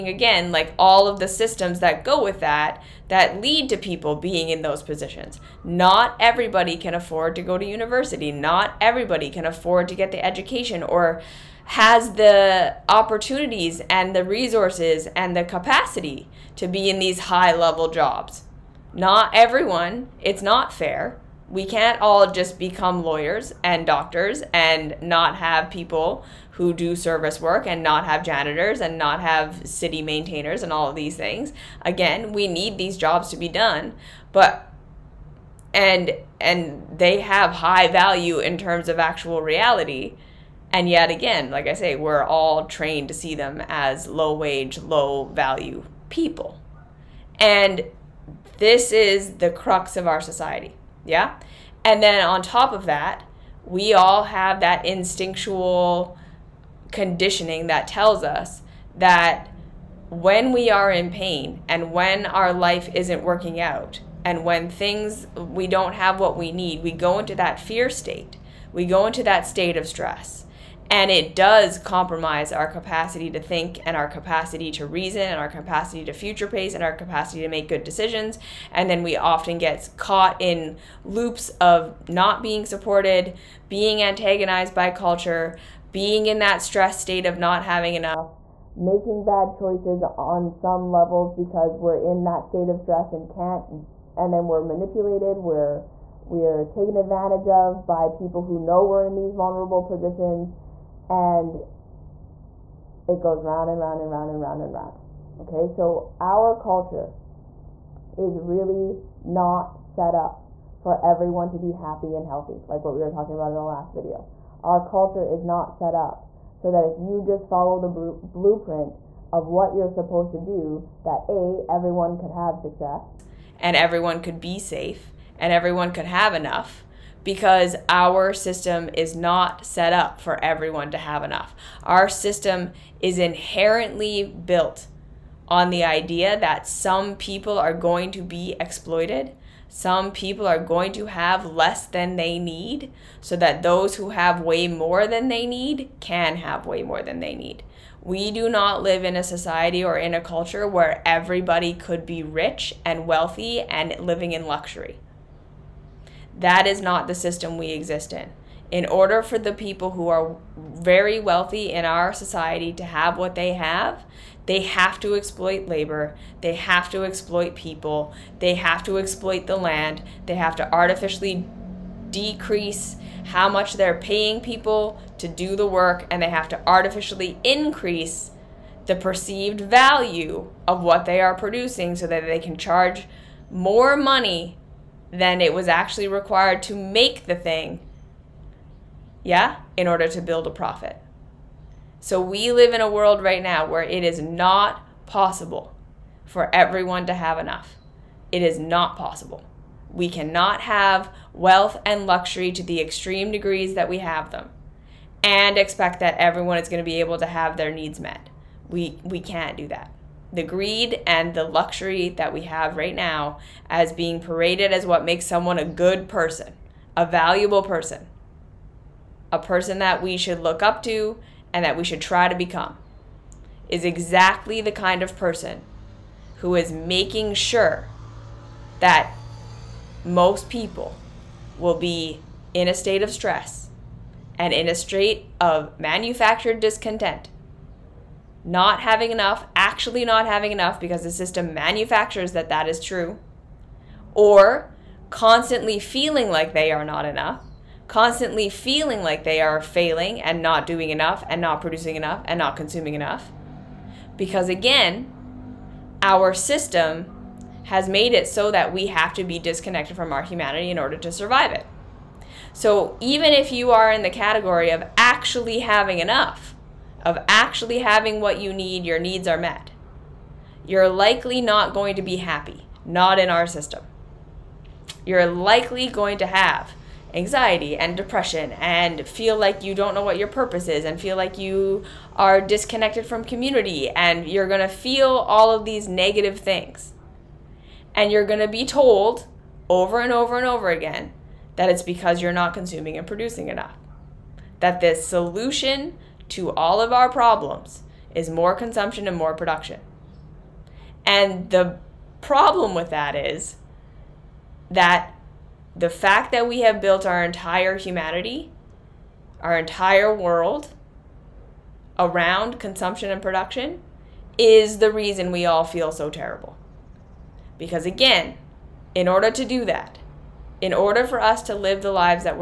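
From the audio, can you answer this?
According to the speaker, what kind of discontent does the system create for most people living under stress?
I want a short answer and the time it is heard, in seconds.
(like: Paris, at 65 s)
manufactured discontent, at 235 s.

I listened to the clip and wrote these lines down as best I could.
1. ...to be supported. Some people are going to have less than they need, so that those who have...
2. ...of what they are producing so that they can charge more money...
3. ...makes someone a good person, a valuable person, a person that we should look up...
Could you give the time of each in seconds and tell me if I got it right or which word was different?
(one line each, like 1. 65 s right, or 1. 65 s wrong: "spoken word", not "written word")
1. 138 s wrong: "exploited", not "supported"
2. 180 s right
3. 215 s right.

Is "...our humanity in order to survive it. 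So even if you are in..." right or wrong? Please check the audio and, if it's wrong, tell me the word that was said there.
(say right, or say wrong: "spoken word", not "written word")
right.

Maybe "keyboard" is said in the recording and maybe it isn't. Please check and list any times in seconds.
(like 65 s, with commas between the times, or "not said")
not said.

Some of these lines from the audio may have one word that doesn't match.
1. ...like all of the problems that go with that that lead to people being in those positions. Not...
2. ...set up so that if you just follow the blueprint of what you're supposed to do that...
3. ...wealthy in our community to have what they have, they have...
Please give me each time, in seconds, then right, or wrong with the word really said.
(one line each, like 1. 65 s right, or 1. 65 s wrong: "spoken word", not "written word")
1. 0 s wrong: "systems", not "problems"
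2. 115 s right
3. 161 s wrong: "society", not "community".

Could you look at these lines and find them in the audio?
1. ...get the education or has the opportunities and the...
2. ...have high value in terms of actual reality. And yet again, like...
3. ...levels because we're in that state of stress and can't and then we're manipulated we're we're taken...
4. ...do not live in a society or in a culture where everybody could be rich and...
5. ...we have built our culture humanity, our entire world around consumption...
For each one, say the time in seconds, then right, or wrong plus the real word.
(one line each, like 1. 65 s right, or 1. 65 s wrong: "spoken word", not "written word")
1. 9 s right
2. 37 s right
3. 90 s right
4. 148 s right
5. 306 s wrong: "entire", not "culture".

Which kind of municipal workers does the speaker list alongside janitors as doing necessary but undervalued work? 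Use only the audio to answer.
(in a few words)
city maintainers.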